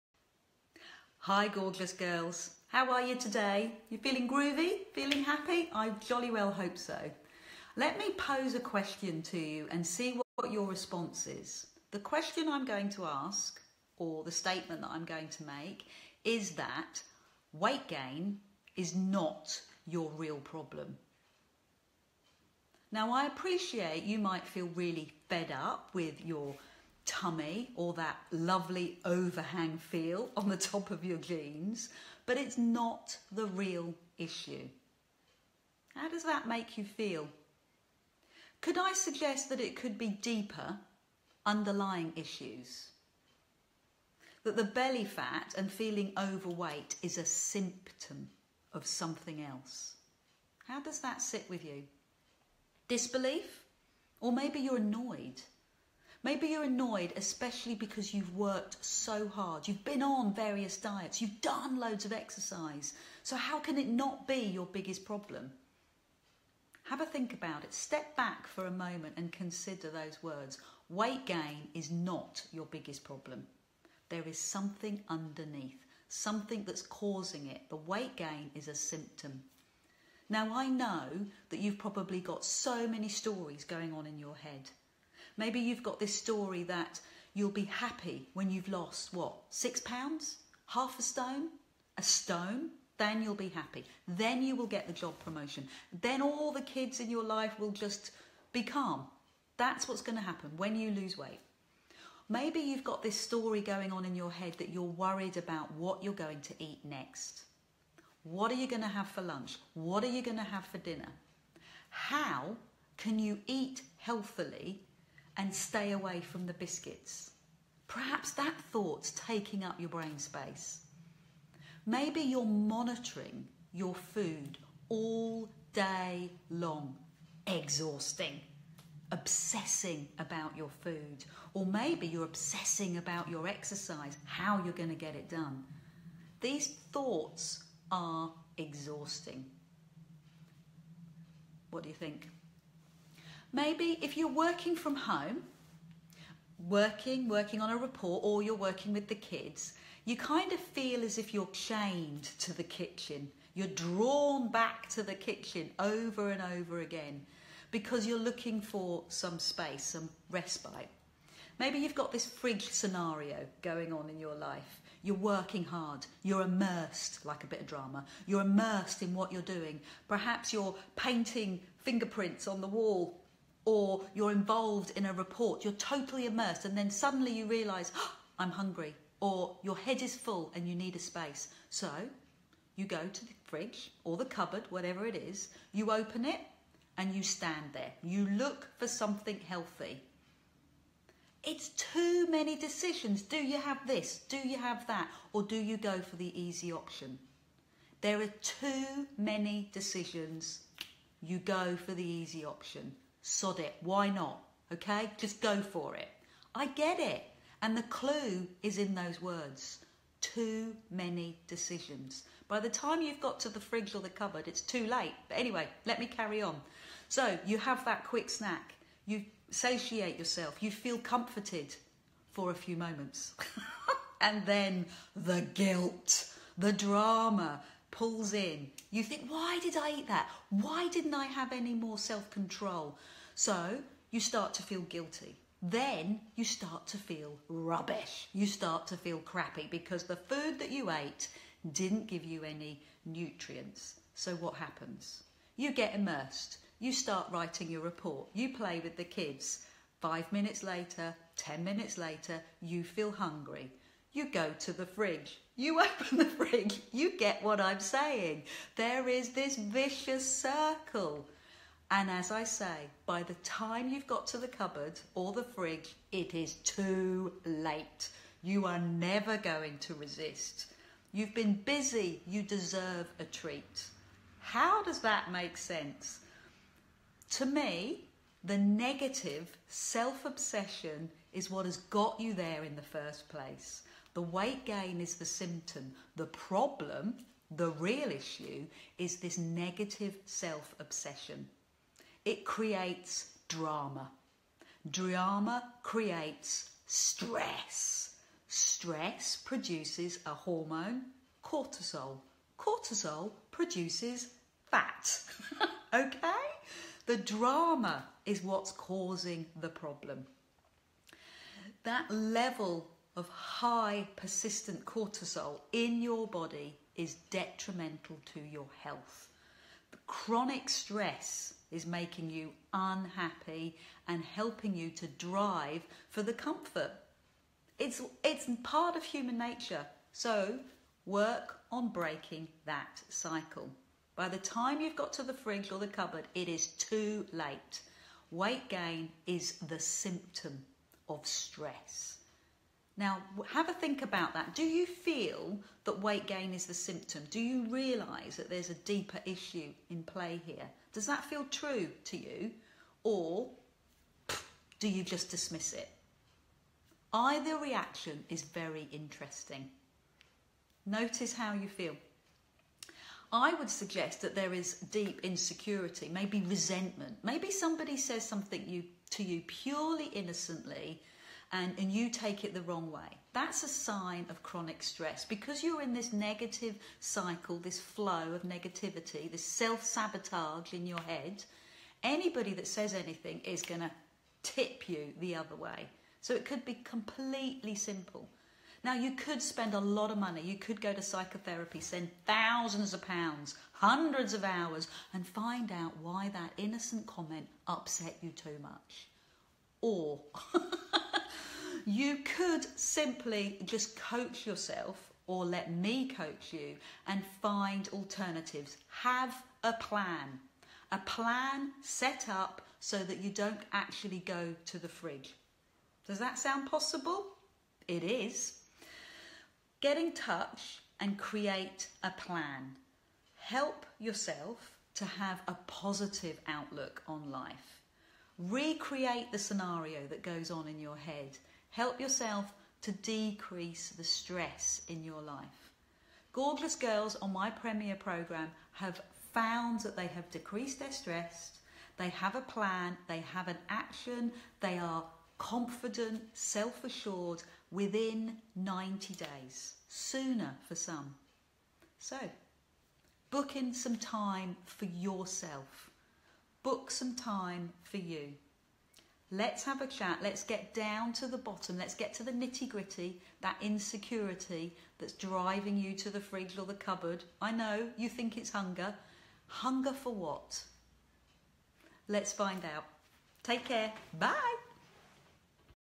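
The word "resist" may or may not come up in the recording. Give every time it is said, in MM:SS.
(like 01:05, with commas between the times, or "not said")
04:29.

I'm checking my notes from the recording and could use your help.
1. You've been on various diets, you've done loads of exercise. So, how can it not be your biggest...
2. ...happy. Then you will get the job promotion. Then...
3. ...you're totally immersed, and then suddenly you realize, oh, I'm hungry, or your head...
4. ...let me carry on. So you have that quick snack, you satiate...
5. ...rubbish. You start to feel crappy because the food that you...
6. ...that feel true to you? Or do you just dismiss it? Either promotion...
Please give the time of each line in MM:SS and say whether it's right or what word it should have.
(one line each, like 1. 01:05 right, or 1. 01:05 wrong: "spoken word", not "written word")
1. 00:59 right
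2. 01:33 right
3. 02:55 right
4. 03:35 right
5. 03:57 right
6. 05:51 wrong: "reaction", not "promotion".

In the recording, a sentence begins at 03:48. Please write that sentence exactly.
You think, why did I eat that?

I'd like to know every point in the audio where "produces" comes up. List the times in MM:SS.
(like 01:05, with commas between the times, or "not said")
04:59, 05:03.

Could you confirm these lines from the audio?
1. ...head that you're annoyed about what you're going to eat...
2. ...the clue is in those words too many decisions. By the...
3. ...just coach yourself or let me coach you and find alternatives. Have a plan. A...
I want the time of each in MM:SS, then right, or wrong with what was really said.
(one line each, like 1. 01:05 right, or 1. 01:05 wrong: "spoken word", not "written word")
1. 01:44 wrong: "worried", not "annoyed"
2. 03:27 right
3. 06:43 right.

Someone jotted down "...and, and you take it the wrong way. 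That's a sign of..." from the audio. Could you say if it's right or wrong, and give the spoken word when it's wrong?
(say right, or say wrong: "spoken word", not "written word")
right.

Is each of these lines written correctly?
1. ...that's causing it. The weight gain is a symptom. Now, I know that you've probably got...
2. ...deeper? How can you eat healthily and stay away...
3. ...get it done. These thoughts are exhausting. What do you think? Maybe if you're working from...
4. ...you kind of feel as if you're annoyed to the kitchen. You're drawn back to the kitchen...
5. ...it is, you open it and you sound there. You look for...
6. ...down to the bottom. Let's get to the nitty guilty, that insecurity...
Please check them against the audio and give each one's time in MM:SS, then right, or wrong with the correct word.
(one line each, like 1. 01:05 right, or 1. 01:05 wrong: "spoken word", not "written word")
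1. 01:16 right
2. 01:50 wrong: "dinner", not "deeper"
3. 02:14 right
4. 02:30 wrong: "chained", not "annoyed"
5. 03:05 wrong: "stand", not "sound"
6. 07:40 wrong: "gritty", not "guilty".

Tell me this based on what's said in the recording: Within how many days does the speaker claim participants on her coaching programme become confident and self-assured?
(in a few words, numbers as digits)
90.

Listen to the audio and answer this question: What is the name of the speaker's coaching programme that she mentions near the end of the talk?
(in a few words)
Premier.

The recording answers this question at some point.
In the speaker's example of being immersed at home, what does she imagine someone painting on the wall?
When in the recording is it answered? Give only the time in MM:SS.
02:51.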